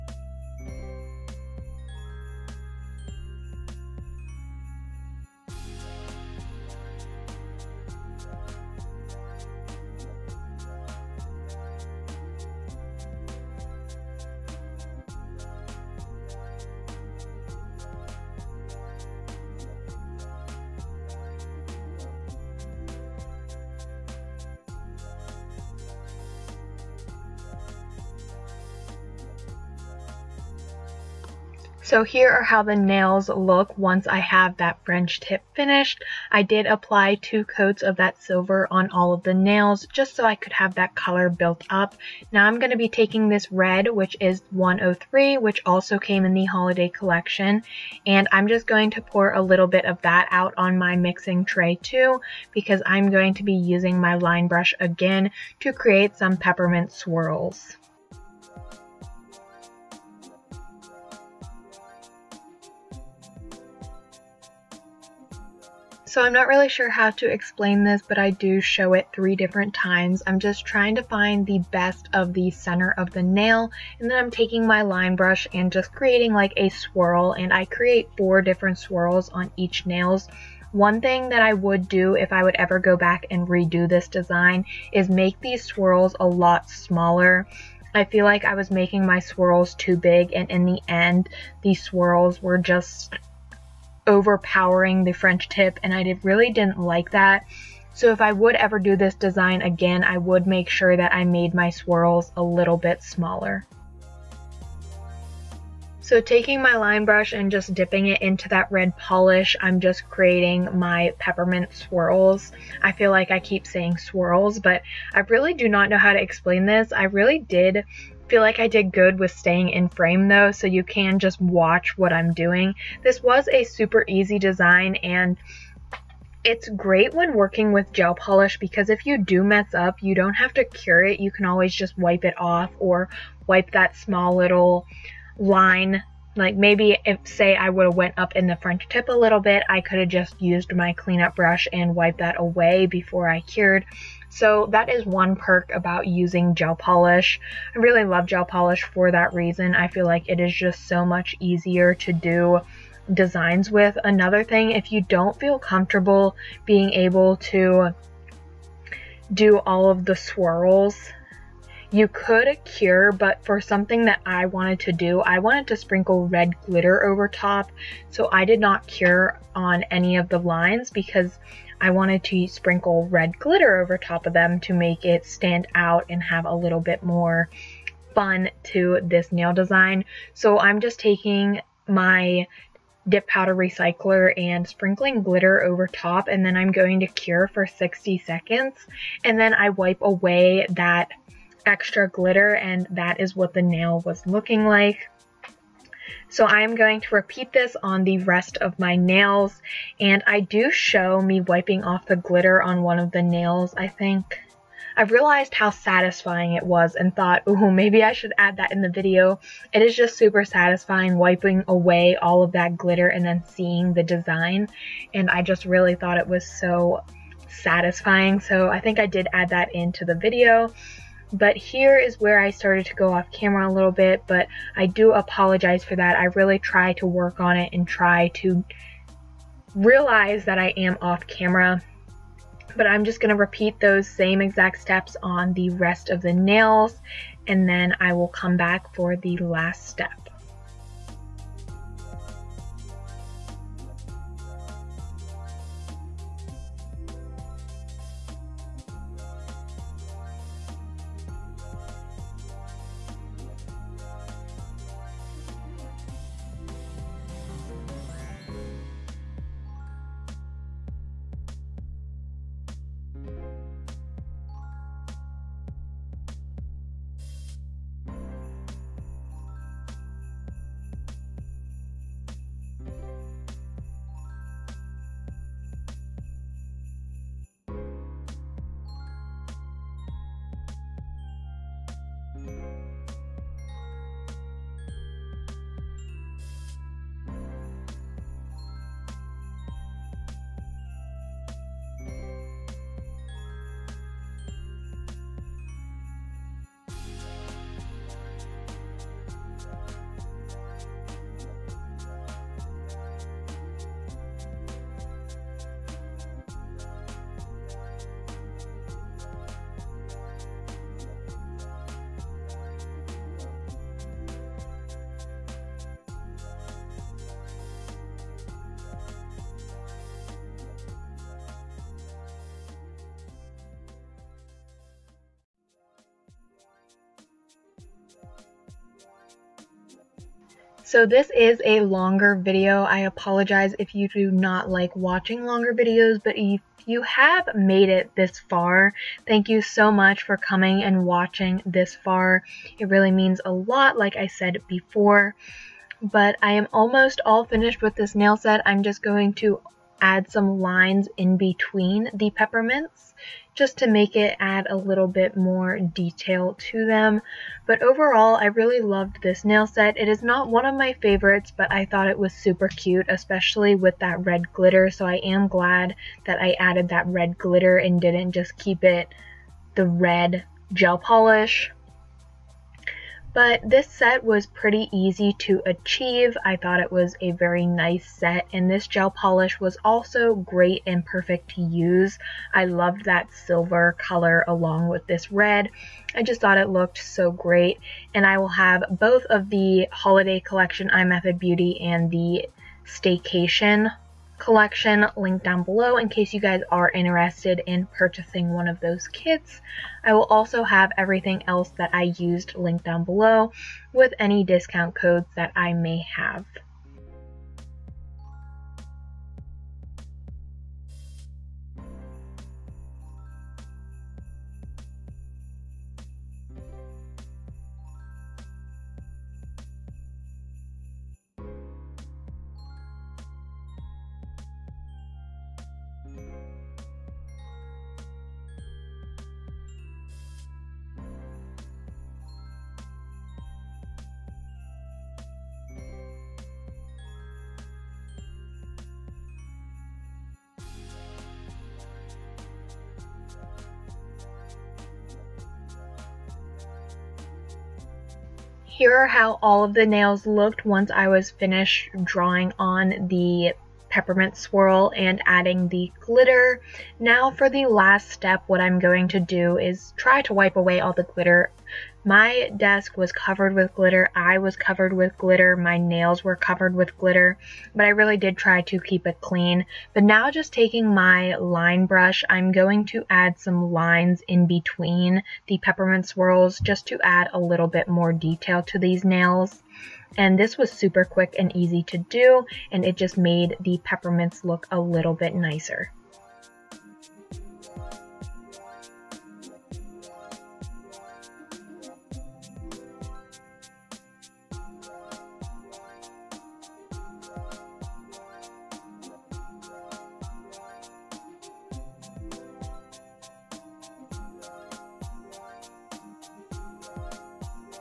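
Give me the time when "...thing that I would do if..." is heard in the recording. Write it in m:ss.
1:21.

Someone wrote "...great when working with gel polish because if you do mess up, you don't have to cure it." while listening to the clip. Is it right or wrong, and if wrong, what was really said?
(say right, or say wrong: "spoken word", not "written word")
right.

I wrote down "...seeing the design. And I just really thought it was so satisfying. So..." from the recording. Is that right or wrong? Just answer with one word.
right.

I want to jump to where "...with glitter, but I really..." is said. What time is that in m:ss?
7:46.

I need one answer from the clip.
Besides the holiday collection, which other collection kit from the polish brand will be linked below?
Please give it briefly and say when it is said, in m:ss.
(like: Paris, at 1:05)
staycation collection, at 6:32.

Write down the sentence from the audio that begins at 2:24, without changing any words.
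So that is one perk about using gel polish.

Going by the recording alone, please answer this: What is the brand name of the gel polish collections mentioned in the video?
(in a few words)
iMethod Beauty.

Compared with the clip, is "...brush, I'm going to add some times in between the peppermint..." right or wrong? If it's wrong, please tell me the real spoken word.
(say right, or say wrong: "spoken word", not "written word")
wrong: "lines", not "times".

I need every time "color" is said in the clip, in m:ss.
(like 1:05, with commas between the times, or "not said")
0:40, 6:23.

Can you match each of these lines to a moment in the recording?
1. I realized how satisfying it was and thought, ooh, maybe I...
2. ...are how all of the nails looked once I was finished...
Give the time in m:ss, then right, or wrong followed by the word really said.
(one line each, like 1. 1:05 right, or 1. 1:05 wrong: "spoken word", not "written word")
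1. 3:24 right
2. 7:28 right.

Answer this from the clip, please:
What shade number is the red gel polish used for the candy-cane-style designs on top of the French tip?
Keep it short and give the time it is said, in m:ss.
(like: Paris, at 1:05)
103, at 0:44.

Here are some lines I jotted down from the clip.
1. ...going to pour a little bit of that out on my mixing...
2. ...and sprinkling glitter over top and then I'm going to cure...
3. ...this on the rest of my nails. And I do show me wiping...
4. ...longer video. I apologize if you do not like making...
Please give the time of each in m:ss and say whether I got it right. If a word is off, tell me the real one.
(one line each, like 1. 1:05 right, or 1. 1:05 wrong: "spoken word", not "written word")
1. 0:48 right
2. 3:04 right
3. 3:17 right
4. 5:31 wrong: "watching", not "making".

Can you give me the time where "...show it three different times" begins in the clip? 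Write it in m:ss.
1:08.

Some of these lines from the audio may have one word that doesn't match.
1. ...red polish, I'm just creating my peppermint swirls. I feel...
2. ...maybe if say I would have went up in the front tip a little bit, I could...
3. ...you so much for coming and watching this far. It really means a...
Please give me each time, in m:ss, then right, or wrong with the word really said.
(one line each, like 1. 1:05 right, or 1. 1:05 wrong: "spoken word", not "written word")
1. 1:48 right
2. 2:16 right
3. 5:39 right.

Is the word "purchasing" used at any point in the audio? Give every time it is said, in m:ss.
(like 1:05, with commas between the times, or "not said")
6:37.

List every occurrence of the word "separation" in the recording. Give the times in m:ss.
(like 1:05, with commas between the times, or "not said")
not said.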